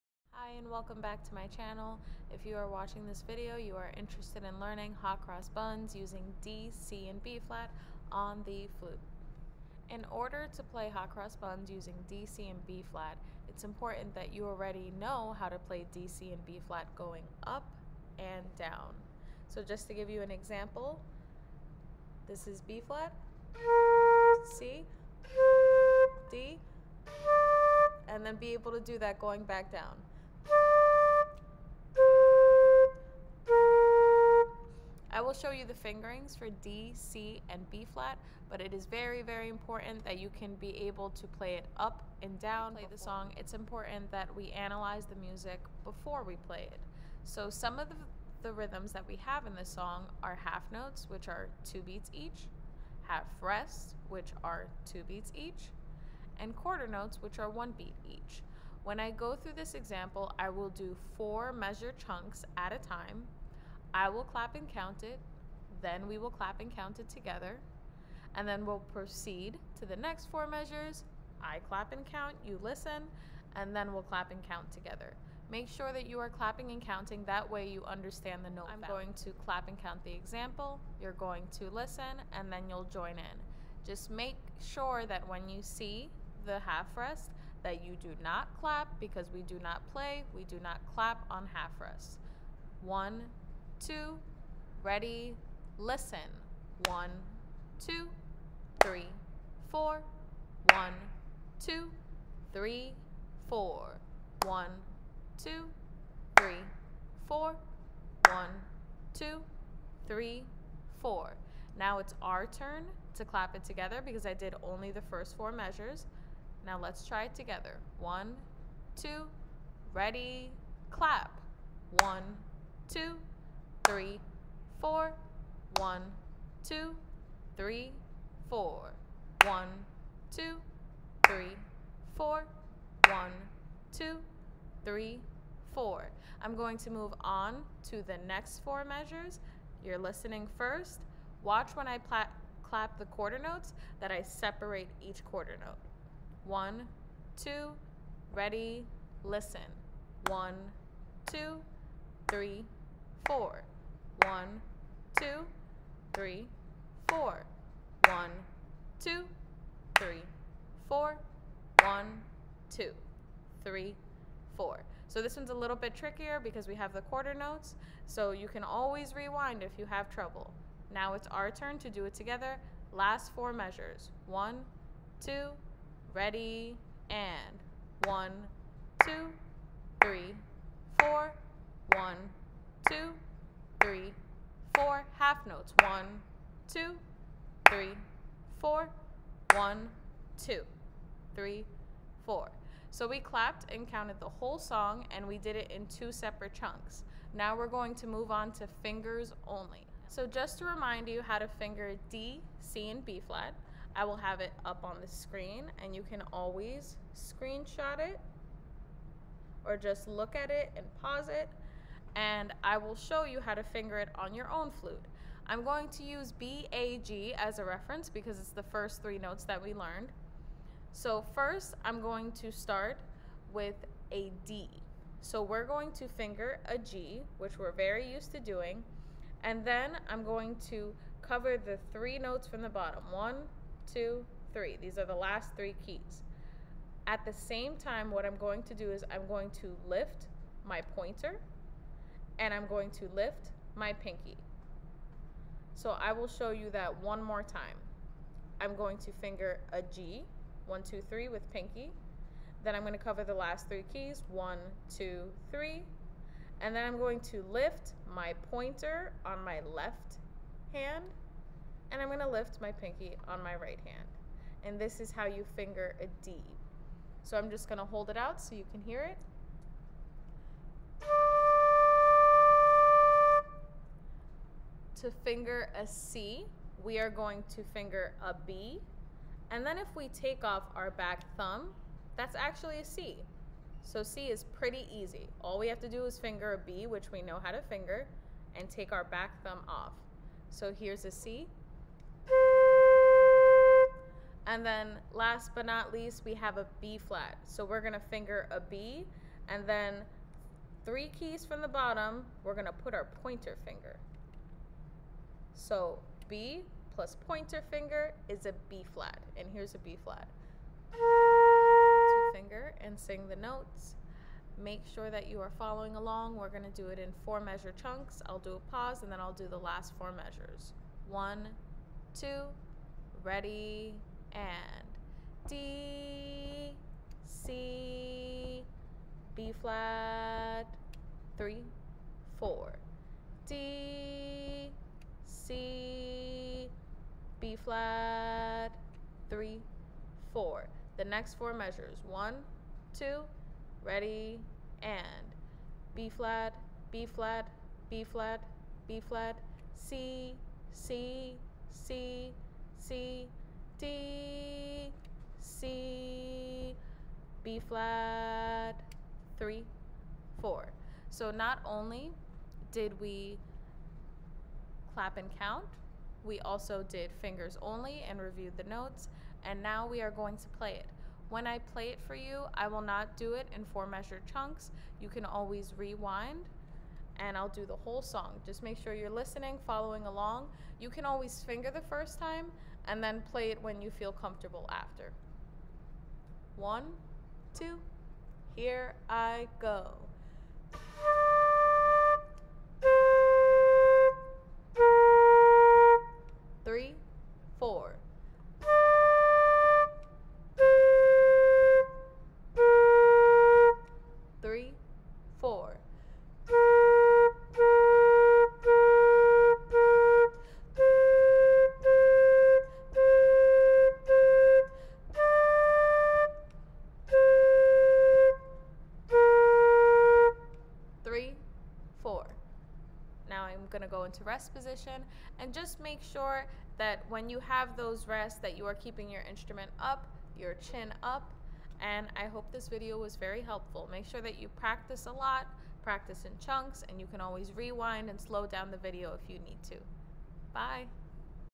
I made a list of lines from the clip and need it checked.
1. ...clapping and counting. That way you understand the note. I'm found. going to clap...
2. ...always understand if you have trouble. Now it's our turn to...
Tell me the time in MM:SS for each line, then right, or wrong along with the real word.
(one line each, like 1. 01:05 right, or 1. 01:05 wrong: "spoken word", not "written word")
1. 01:16 right
2. 02:48 wrong: "rewind", not "understand".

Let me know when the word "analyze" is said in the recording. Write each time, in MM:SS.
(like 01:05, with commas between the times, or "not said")
00:44.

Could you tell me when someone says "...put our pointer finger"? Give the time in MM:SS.
05:02.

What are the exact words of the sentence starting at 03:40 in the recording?
So first, I'm going to start with a D.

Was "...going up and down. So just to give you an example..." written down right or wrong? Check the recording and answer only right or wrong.
right.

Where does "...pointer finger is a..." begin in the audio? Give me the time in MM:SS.
05:07.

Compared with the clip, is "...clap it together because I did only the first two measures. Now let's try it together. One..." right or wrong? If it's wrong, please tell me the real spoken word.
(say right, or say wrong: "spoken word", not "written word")
wrong: "four", not "two".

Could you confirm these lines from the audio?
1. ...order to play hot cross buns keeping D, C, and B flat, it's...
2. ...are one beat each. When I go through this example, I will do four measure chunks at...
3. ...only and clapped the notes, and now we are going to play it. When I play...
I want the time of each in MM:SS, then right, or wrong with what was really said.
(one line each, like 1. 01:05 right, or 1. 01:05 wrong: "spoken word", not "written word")
1. 00:10 wrong: "using", not "keeping"
2. 00:57 right
3. 06:07 wrong: "reviewed", not "clapped".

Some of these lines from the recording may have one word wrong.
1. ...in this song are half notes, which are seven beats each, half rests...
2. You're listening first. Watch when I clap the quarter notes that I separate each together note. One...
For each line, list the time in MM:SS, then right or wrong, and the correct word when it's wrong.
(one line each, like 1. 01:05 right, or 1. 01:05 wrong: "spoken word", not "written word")
1. 00:49 wrong: "two", not "seven"
2. 02:19 wrong: "quarter", not "together".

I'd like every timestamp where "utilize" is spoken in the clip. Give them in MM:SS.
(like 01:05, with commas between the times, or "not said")
not said.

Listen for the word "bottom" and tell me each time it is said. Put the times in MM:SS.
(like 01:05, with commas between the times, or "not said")
03:52, 05:01.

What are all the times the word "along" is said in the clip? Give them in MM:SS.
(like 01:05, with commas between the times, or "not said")
05:15, 06:20.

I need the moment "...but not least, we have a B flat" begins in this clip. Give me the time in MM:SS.
04:55.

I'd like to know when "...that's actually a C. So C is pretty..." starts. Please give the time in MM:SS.
04:42.